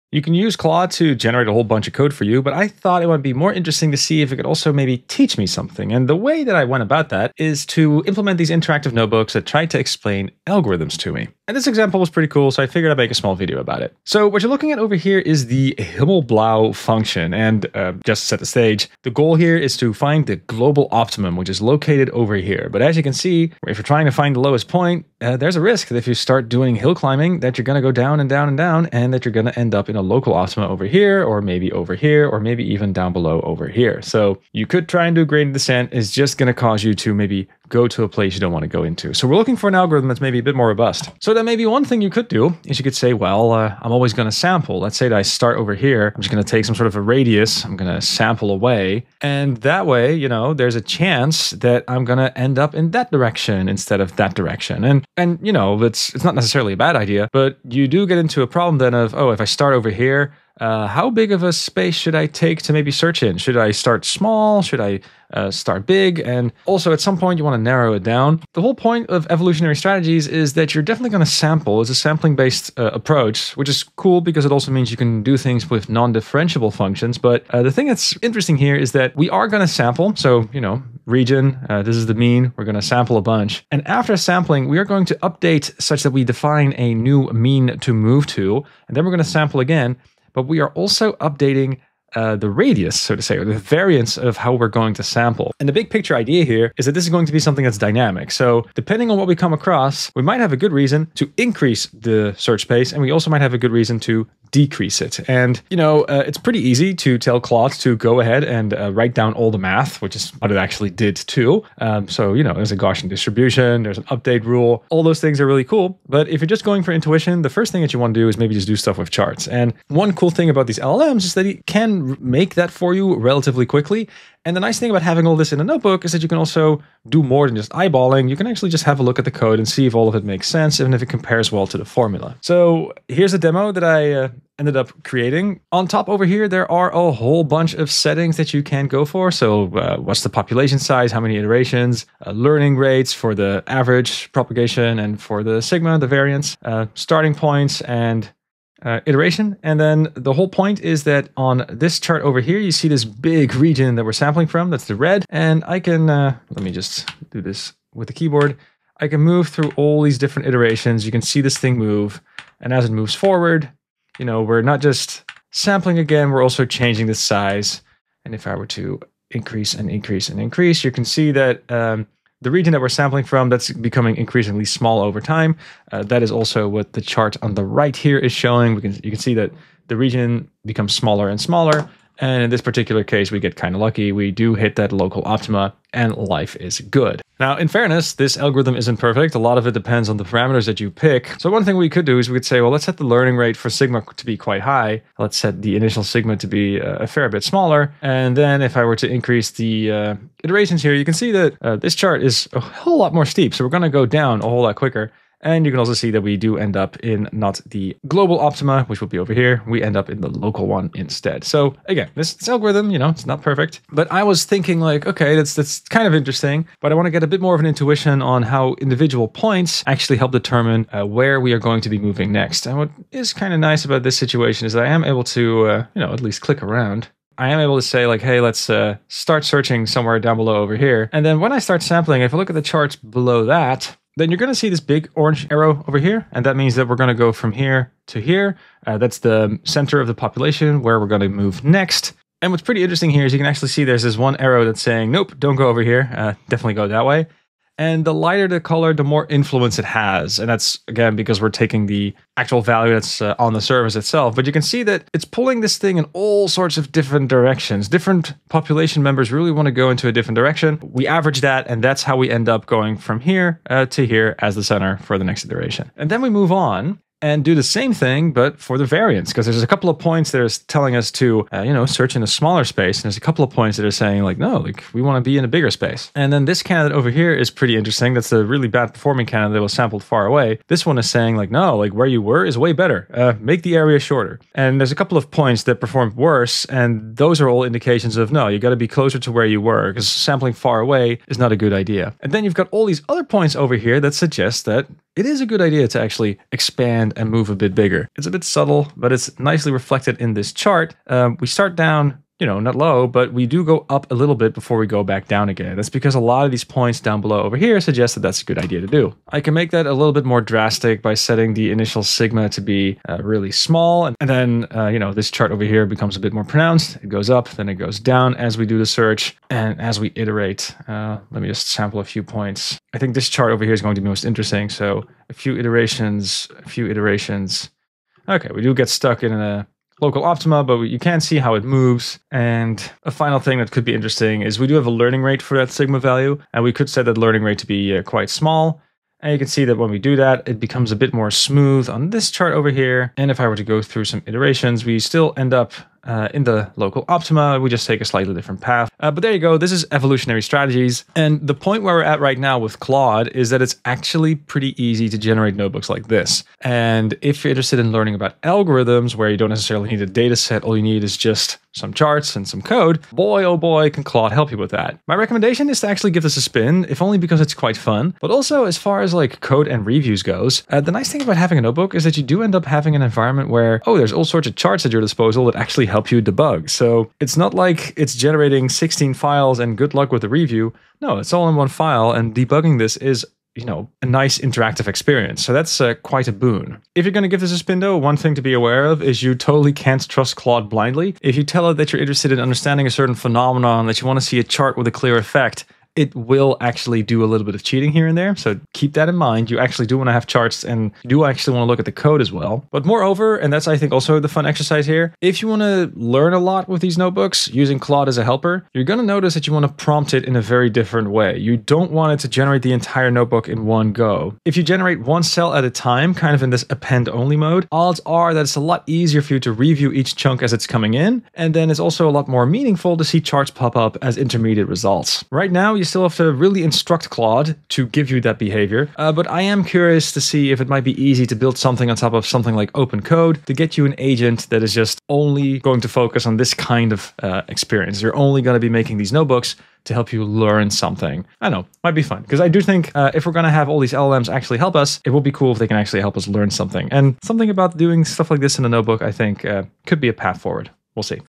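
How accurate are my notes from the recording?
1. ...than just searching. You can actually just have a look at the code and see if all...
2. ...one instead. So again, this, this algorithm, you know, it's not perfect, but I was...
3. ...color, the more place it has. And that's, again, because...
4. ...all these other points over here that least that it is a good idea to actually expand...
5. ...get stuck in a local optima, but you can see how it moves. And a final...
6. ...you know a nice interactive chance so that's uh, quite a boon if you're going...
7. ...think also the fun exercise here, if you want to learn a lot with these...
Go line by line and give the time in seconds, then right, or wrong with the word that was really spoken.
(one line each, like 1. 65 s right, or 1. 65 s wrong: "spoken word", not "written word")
1. 127 s wrong: "eyeballing", not "searching"
2. 210 s right
3. 248 s wrong: "influence", not "place"
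4. 292 s wrong: "suggest", not "least"
5. 328 s right
6. 383 s wrong: "experience", not "chance"
7. 403 s right.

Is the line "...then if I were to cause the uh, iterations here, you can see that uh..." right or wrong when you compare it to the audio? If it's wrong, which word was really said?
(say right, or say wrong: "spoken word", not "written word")
wrong: "increase", not "cause".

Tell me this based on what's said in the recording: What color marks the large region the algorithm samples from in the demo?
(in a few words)
Red.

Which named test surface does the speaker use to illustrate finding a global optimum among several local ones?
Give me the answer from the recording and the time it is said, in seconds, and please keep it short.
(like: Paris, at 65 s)
Himmelblau function, at 15 s.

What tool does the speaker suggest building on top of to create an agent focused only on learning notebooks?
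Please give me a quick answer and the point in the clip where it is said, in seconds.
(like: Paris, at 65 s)
Open code, at 432 s.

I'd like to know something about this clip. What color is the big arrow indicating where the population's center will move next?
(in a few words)
Orange.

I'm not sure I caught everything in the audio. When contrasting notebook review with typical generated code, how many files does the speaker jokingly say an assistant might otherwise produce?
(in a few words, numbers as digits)
16.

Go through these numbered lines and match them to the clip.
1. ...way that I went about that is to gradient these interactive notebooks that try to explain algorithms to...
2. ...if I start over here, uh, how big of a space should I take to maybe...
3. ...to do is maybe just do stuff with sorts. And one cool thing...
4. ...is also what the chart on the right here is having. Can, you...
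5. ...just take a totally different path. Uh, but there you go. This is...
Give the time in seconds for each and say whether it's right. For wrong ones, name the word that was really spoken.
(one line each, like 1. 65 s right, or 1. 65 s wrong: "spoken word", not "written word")
1. 6 s wrong: "implement", not "gradient"
2. 59 s right
3. 118 s wrong: "charts", not "sorts"
4. 176 s wrong: "showing", not "having"
5. 347 s wrong: "slightly", not "totally".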